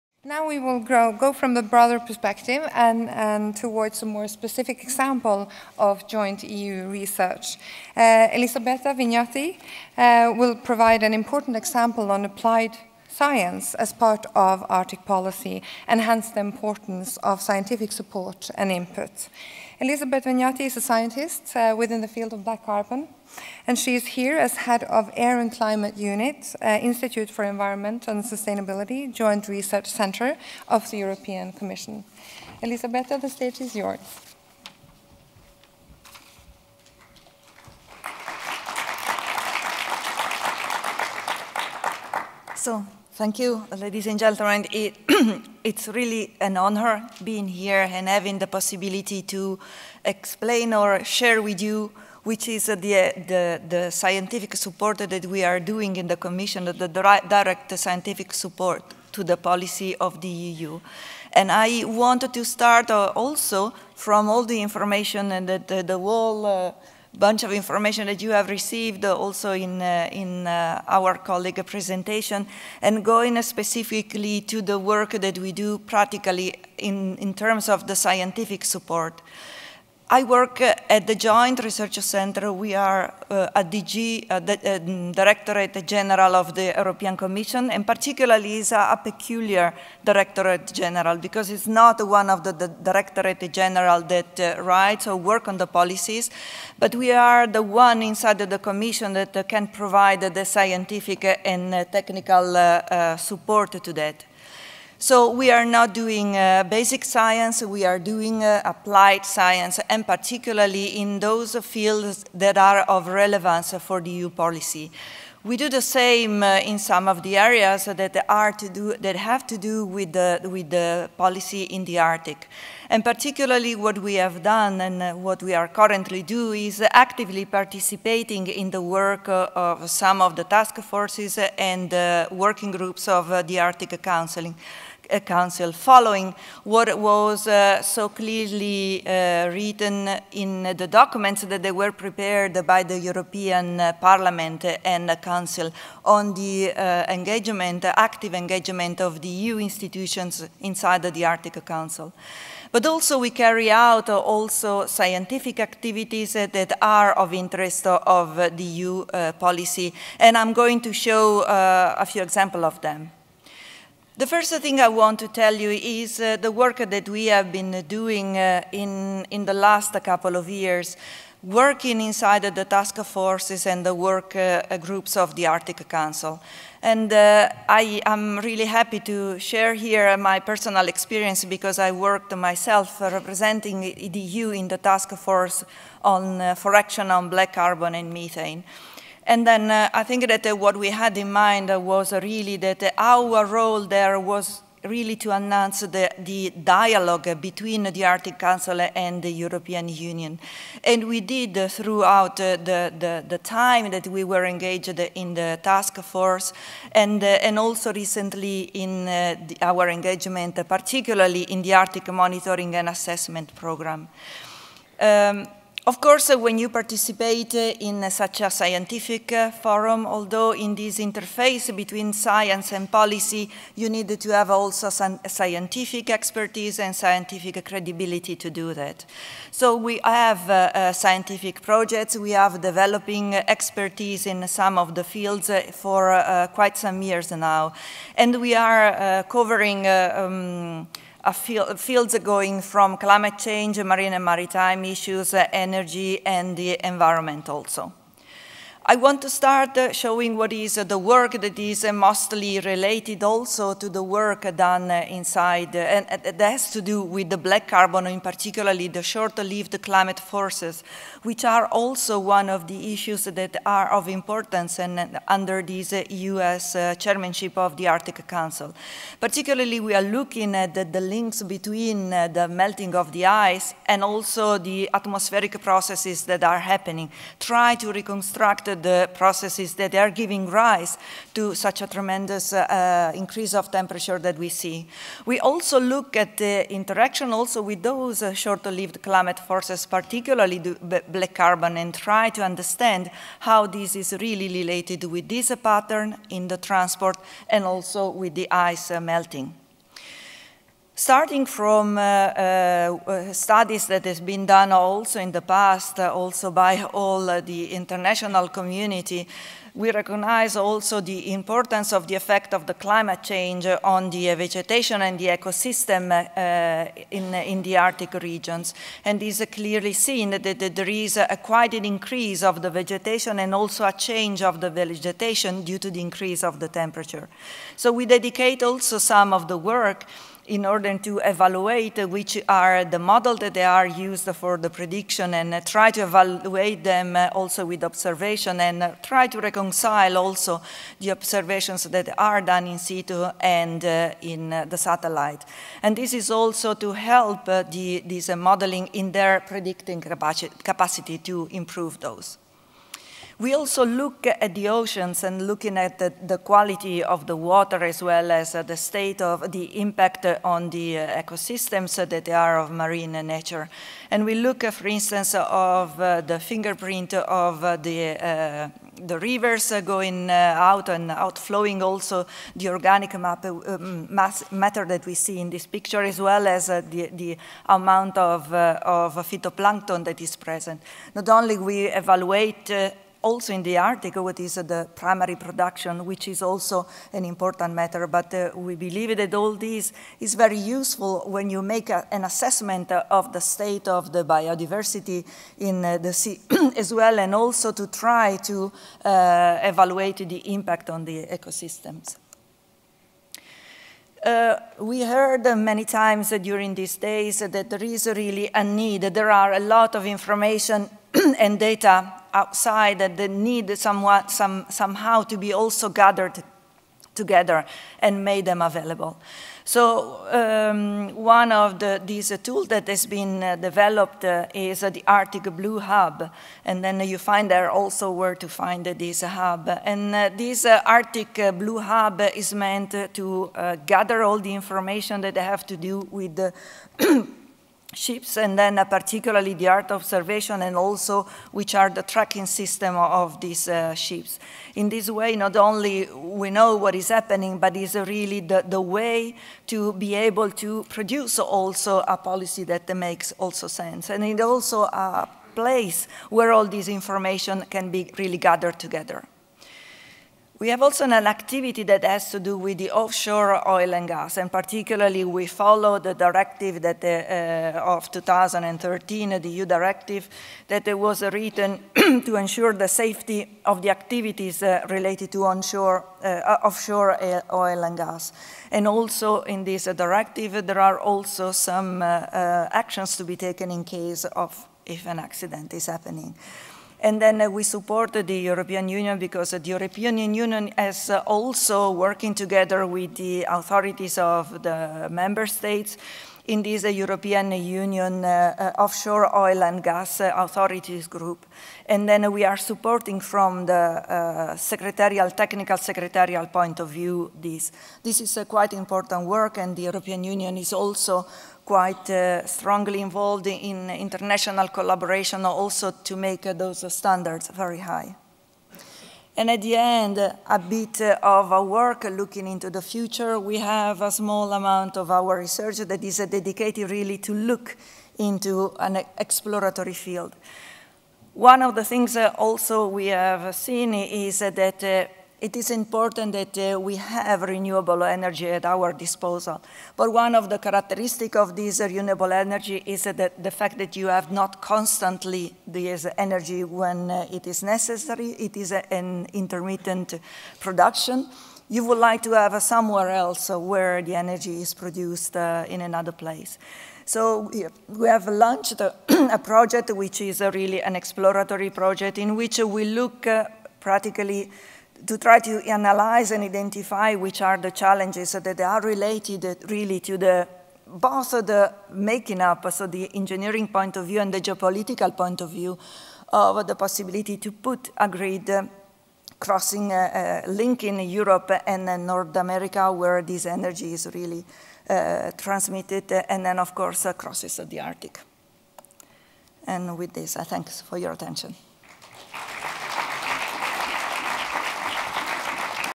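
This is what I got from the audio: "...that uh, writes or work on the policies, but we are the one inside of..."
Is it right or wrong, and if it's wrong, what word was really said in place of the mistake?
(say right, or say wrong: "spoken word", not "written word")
right.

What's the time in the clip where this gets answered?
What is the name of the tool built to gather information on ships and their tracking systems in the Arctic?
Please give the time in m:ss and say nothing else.
7:05.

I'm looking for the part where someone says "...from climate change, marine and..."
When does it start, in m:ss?
4:02.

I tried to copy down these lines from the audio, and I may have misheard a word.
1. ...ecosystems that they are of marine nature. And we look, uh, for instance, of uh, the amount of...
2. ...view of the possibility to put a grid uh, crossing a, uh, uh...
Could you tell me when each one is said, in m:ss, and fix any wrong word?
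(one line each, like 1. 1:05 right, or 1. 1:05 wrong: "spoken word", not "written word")
1. 6:01 wrong: "fingerprint", not "amount"
2. 9:35 right.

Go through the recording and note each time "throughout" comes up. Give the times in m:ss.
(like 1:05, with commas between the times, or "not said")
3:21.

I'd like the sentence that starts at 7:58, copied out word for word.
And also in this directive, there are also some actions to be taken in case of if an accident is happening.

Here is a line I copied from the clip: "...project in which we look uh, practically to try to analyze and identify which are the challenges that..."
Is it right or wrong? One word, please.
right.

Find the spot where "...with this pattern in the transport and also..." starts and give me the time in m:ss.
4:55.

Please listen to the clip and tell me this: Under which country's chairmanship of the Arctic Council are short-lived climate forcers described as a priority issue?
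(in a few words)
U.S.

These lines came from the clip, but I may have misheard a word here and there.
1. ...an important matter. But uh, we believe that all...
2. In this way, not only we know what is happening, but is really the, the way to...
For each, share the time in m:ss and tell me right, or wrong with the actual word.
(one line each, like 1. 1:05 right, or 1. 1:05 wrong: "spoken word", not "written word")
1. 6:27 right
2. 7:24 right.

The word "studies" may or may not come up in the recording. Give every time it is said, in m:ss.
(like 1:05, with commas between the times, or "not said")
5:03.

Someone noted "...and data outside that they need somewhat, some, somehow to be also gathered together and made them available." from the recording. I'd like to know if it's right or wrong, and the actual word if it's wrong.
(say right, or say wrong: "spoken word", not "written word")
right.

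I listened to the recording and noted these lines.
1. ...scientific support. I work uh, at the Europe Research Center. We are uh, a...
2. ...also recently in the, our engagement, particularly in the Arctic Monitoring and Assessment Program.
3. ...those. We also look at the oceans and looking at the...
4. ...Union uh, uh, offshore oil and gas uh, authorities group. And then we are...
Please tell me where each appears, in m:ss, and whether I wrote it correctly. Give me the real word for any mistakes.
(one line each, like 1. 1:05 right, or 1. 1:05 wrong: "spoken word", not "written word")
1. 1:17 wrong: "Joint", not "Europe"
2. 3:27 right
3. 5:51 right
4. 8:17 right.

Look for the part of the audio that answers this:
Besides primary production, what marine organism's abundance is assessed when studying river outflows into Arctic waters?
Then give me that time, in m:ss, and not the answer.
6:19.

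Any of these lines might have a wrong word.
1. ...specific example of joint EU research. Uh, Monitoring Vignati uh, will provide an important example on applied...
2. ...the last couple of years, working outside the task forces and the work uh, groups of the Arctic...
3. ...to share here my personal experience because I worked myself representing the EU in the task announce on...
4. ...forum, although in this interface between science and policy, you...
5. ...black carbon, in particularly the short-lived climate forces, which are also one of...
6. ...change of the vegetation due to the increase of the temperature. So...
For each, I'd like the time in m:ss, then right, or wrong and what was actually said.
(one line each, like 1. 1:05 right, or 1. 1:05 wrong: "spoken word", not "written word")
1. 0:04 wrong: "Elisabetta", not "Monitoring"
2. 2:49 wrong: "inside", not "outside"
3. 2:58 wrong: "force", not "announce"
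4. 3:39 right
5. 4:17 right
6. 5:24 right.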